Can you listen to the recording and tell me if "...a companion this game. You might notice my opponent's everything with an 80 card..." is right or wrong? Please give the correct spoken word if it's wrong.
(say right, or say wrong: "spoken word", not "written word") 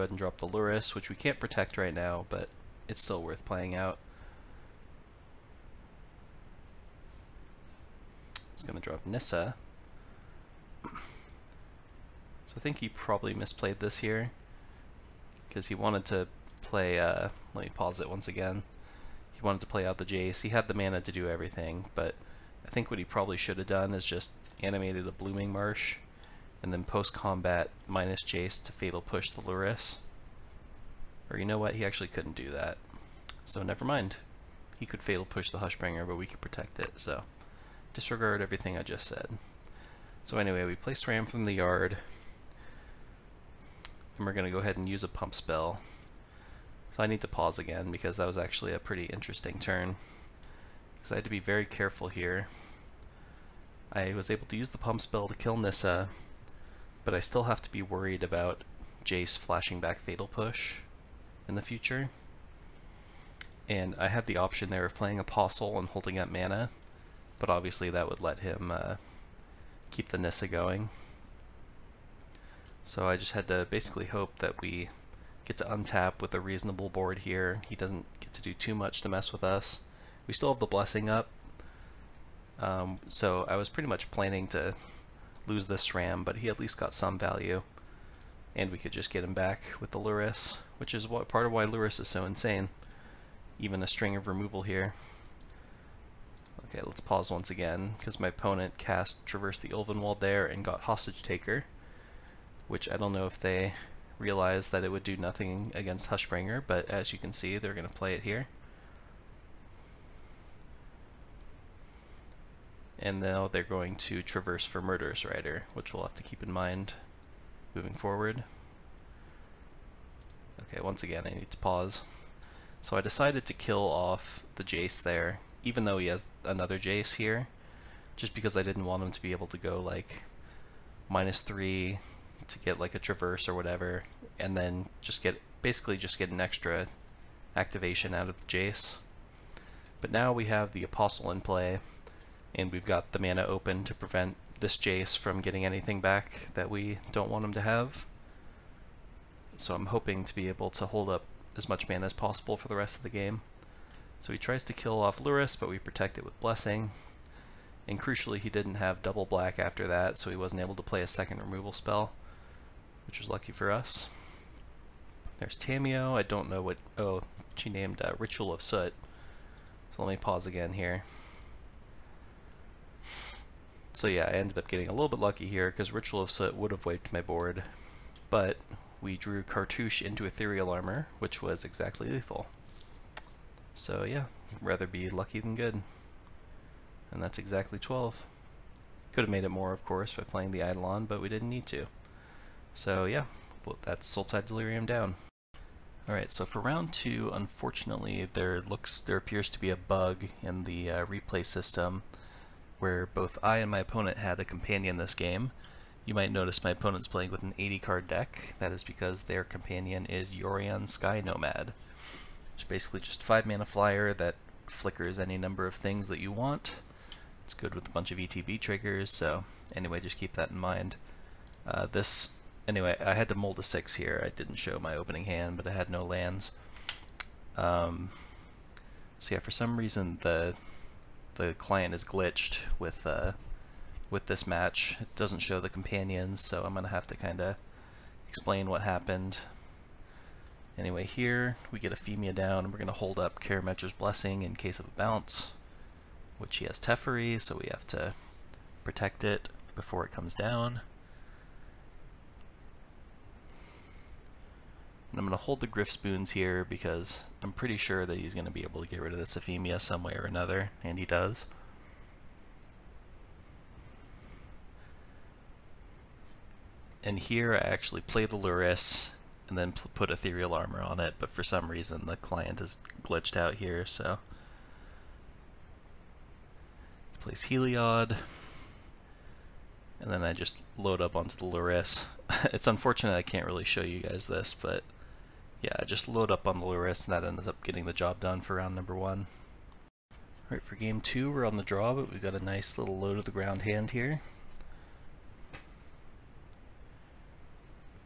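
wrong: "playing", not "everything".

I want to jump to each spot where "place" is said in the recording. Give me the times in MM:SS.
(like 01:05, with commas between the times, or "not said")
00:40, 04:37.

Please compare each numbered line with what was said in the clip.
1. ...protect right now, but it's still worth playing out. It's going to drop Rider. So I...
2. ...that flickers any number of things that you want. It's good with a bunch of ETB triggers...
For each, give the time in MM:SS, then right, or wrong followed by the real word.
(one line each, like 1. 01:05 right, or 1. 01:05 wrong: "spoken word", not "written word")
1. 00:01 wrong: "Nissa", not "Rider"
2. 03:34 right.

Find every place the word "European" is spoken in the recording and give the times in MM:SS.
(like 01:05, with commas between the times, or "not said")
not said.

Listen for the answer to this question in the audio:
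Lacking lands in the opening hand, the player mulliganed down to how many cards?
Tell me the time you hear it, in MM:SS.
03:43.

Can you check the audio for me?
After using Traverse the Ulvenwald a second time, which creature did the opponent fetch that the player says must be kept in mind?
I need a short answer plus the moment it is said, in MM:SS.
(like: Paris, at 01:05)
Murderous Rider, at 01:54.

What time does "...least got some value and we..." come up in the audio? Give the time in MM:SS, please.
01:26.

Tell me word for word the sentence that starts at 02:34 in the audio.
So he tries to kill off Lurrus, but we protect it with Blessing.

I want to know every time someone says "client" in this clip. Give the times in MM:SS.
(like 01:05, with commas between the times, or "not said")
03:51, 04:32.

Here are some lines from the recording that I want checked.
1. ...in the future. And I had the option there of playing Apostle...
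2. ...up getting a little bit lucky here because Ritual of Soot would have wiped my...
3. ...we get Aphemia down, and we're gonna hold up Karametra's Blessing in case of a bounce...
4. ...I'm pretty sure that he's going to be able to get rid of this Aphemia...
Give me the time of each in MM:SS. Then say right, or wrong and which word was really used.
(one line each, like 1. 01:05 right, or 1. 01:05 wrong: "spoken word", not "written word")
1. 01:01 right
2. 02:54 right
3. 04:01 right
4. 04:17 right.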